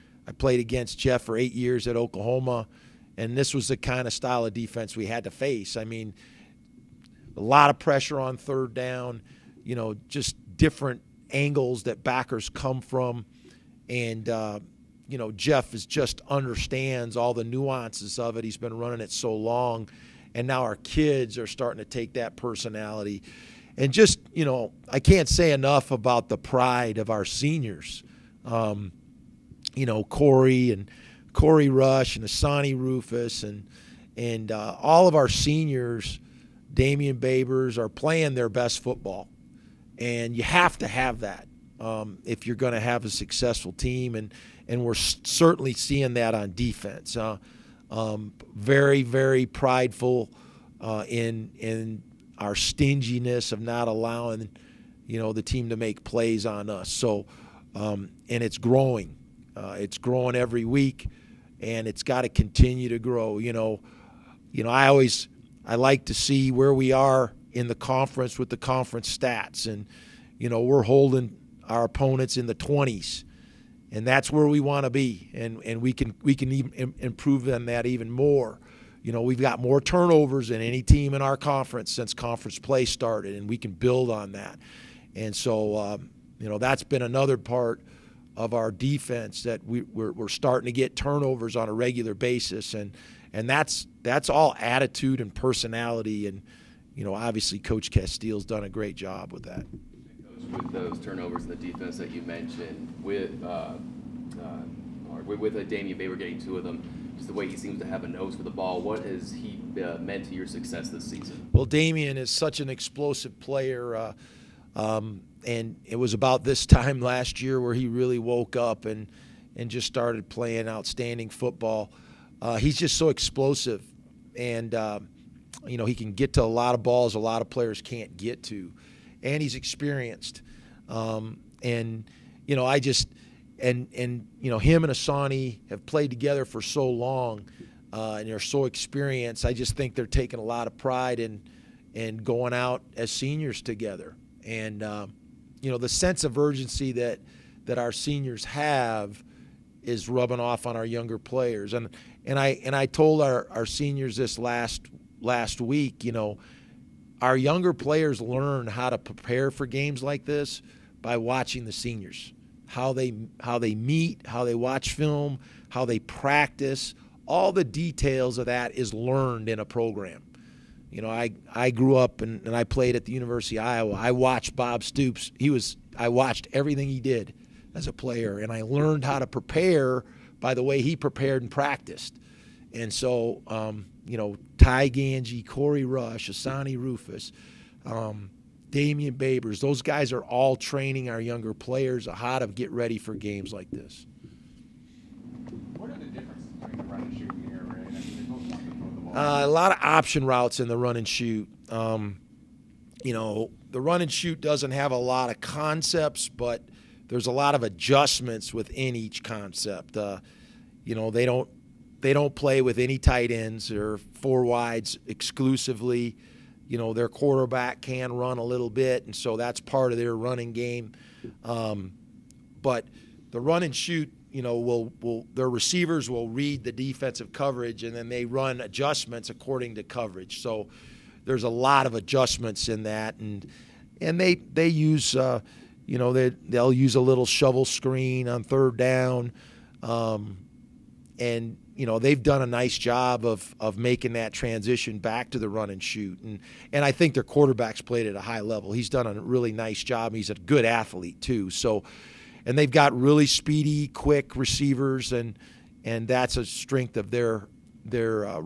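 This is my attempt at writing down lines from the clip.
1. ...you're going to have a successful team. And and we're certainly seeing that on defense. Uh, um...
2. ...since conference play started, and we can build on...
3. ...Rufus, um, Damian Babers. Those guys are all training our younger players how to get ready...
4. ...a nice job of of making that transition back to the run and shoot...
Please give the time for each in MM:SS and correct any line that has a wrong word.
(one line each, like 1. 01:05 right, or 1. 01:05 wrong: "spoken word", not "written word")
1. 00:42 right
2. 01:21 right
3. 03:06 right
4. 04:02 right.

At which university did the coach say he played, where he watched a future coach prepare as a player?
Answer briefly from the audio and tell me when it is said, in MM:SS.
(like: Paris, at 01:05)
University of Iowa, at 02:53.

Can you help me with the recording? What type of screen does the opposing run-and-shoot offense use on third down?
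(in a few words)
shovel screen.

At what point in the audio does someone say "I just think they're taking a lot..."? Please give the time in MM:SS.
02:19.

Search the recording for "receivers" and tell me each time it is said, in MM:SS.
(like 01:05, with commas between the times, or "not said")
03:45, 04:14.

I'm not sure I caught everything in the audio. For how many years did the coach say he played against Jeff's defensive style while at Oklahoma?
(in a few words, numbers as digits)
8.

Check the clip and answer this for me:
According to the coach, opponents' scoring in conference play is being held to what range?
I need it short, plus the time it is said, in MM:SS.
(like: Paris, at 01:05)
the 20s, at 01:12.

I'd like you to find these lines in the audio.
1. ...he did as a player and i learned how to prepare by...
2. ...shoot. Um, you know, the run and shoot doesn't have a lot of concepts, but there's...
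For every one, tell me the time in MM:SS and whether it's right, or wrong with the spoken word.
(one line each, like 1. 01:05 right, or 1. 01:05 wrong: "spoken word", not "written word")
1. 02:56 right
2. 03:21 right.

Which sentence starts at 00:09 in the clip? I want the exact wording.
You know, just different angles that backers come from, and uh, you know, Jeff is just understands all the nuances of it.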